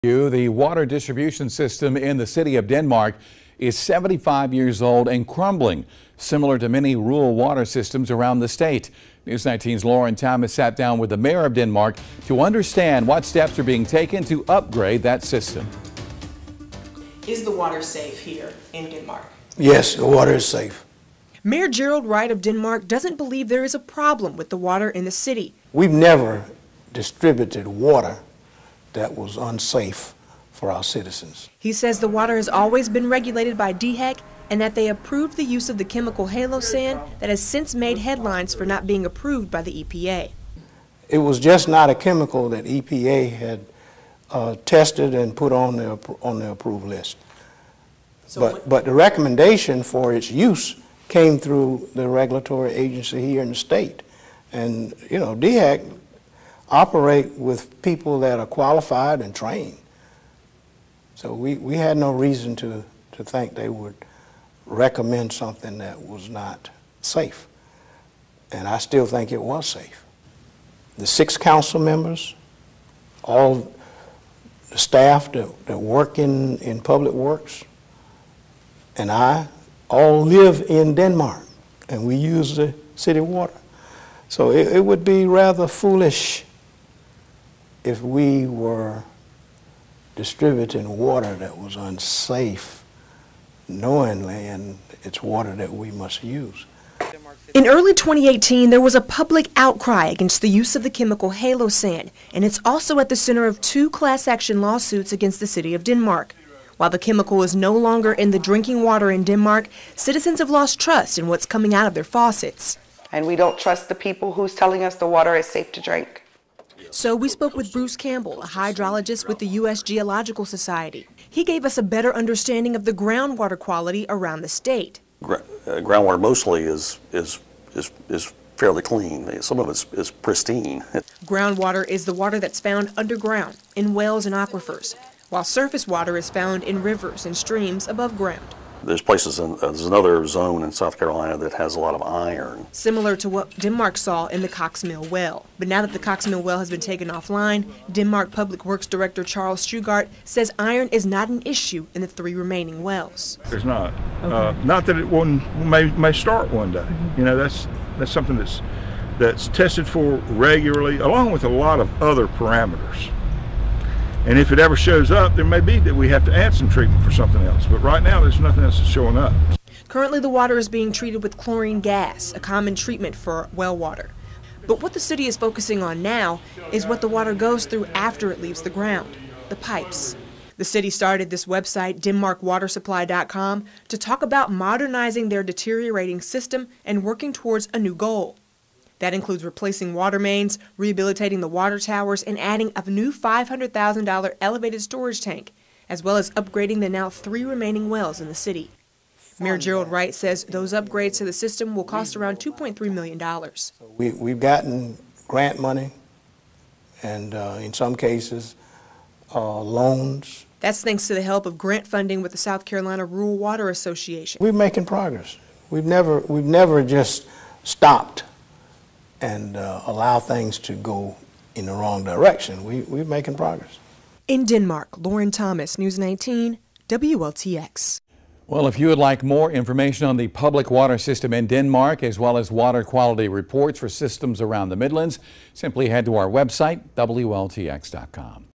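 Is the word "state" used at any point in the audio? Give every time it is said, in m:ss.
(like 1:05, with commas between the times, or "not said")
0:08, 0:53, 2:04.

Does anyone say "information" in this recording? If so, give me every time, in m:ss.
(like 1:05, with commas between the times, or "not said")
3:49.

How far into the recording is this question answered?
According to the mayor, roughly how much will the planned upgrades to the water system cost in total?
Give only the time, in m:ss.
3:22.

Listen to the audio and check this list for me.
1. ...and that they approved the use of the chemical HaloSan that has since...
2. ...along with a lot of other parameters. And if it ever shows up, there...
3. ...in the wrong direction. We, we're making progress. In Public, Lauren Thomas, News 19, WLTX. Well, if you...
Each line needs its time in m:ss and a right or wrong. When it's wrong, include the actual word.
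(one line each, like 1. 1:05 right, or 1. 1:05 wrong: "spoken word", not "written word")
1. 0:34 right
2. 2:41 right
3. 3:41 wrong: "Denmark", not "Public".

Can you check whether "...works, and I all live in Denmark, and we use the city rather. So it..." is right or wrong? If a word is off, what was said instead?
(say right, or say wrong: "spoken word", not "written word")
wrong: "water", not "rather".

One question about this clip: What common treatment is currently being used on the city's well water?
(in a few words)
Chlorine gas.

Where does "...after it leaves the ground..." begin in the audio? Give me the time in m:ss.
2:57.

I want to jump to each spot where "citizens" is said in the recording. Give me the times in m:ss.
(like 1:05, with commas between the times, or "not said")
0:30, 1:49.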